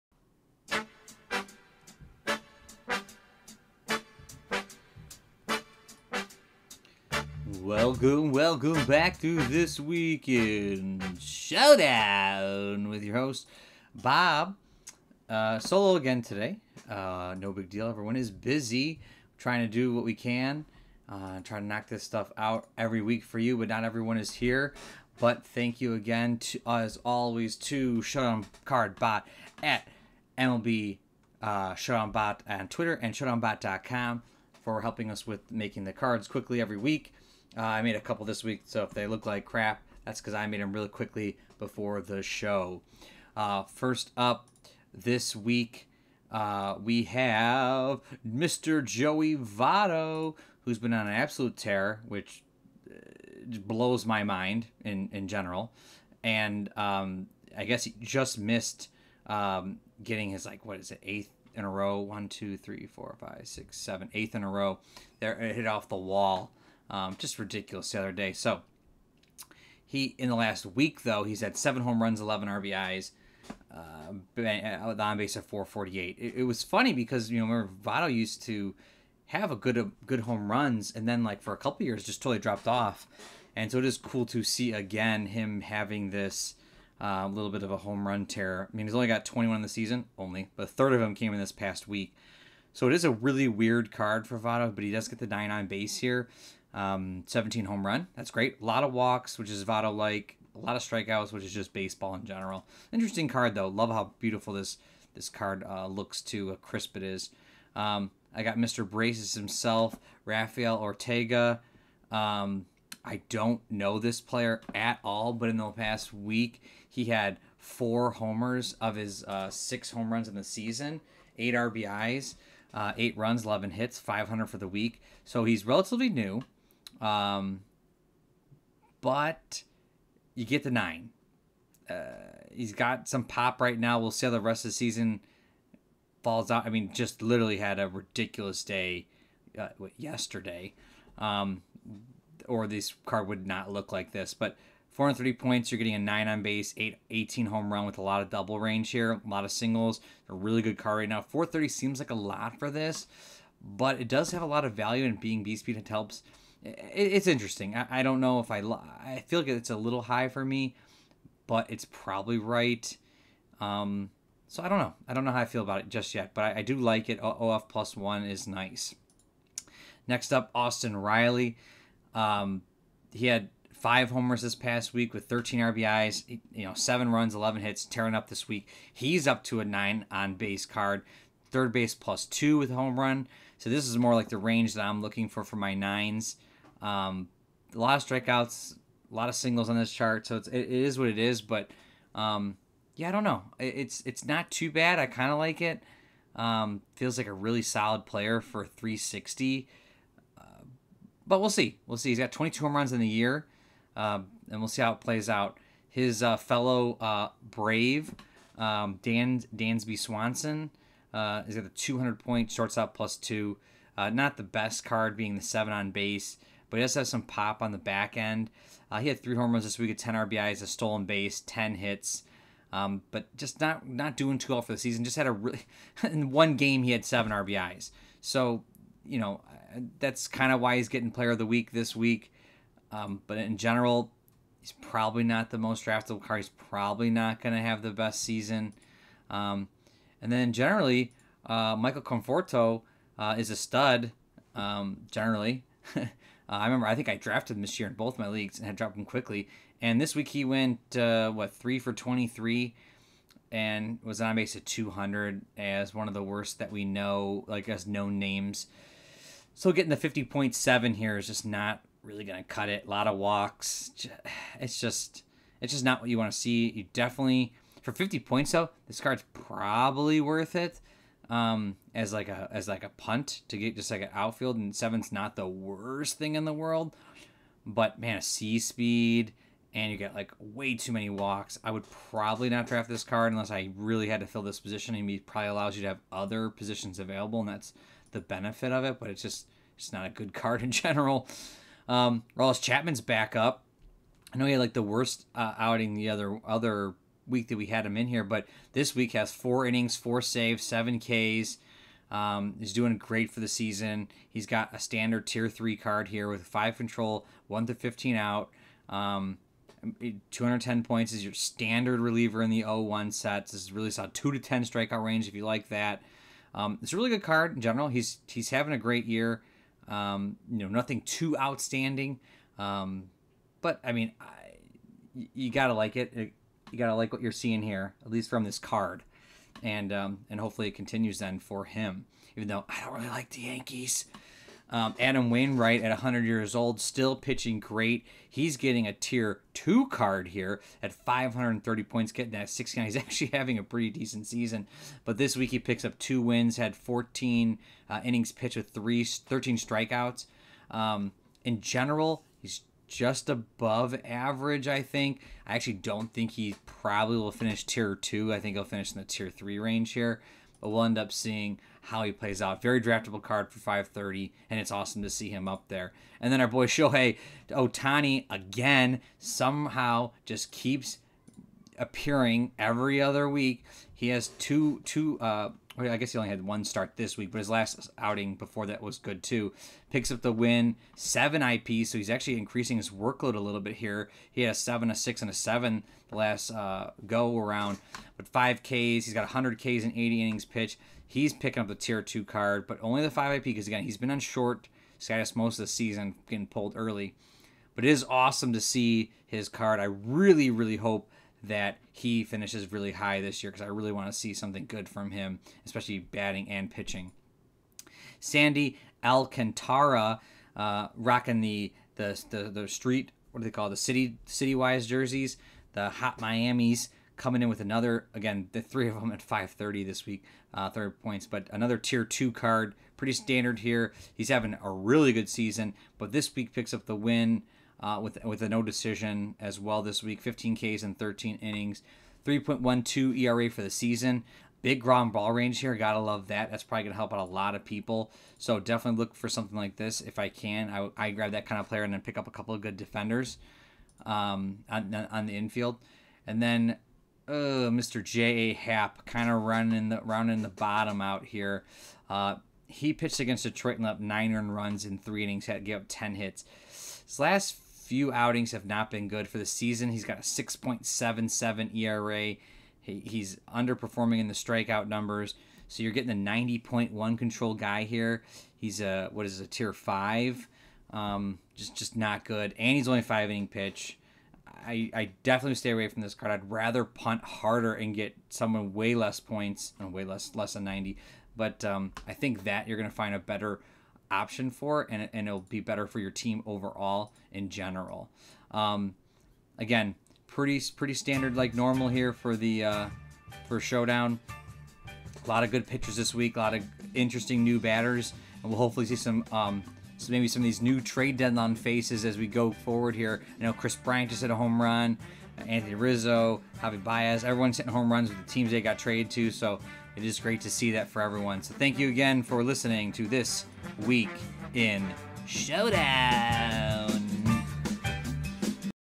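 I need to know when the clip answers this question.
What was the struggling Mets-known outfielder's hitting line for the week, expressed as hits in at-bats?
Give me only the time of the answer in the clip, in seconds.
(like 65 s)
251 s.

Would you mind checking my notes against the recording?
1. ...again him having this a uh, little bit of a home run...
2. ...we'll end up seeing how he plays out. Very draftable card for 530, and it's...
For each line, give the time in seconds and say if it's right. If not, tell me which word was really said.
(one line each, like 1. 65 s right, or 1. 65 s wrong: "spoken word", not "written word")
1. 84 s right
2. 360 s right.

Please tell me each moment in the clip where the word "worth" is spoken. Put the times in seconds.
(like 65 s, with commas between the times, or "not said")
270 s.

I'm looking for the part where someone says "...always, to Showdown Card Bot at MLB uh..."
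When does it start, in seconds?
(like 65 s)
27 s.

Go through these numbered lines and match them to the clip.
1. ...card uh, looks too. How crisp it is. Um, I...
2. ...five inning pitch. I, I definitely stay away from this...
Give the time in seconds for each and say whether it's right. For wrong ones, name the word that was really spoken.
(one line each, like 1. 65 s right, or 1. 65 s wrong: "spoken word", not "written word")
1. 105 s right
2. 473 s right.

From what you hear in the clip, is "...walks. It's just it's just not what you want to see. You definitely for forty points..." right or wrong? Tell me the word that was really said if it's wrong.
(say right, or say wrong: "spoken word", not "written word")
wrong: "fifty", not "forty".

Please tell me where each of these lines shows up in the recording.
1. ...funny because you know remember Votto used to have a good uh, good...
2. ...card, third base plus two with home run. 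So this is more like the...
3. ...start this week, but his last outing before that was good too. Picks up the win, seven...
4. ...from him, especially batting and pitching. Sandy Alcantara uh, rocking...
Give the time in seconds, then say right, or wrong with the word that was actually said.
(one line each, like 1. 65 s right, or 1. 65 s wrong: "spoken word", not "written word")
1. 76 s right
2. 180 s right
3. 376 s right
4. 404 s right.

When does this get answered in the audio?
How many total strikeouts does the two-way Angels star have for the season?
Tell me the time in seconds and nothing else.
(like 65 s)
389 s.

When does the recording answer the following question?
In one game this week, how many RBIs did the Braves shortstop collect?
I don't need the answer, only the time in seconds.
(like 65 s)
227 s.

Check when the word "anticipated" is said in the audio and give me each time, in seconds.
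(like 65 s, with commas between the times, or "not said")
not said.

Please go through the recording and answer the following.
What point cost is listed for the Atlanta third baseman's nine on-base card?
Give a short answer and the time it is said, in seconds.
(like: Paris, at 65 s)
360, at 198 s.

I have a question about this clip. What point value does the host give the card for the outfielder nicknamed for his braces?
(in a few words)
430.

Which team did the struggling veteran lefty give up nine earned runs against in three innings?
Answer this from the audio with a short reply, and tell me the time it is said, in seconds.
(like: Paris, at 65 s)
Detroit, at 453 s.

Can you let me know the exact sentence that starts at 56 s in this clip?
And um, I guess he just missed um, getting his, like, what is it, eighth in a row?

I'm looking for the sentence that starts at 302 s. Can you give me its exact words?
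Um, he's doing great for the season.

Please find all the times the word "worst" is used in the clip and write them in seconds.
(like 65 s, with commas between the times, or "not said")
256 s, 275 s, 294 s.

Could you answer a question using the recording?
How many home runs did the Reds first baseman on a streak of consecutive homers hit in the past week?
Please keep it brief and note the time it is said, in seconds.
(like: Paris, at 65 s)
7, at 71 s.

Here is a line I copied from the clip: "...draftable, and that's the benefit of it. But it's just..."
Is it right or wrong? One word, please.
wrong.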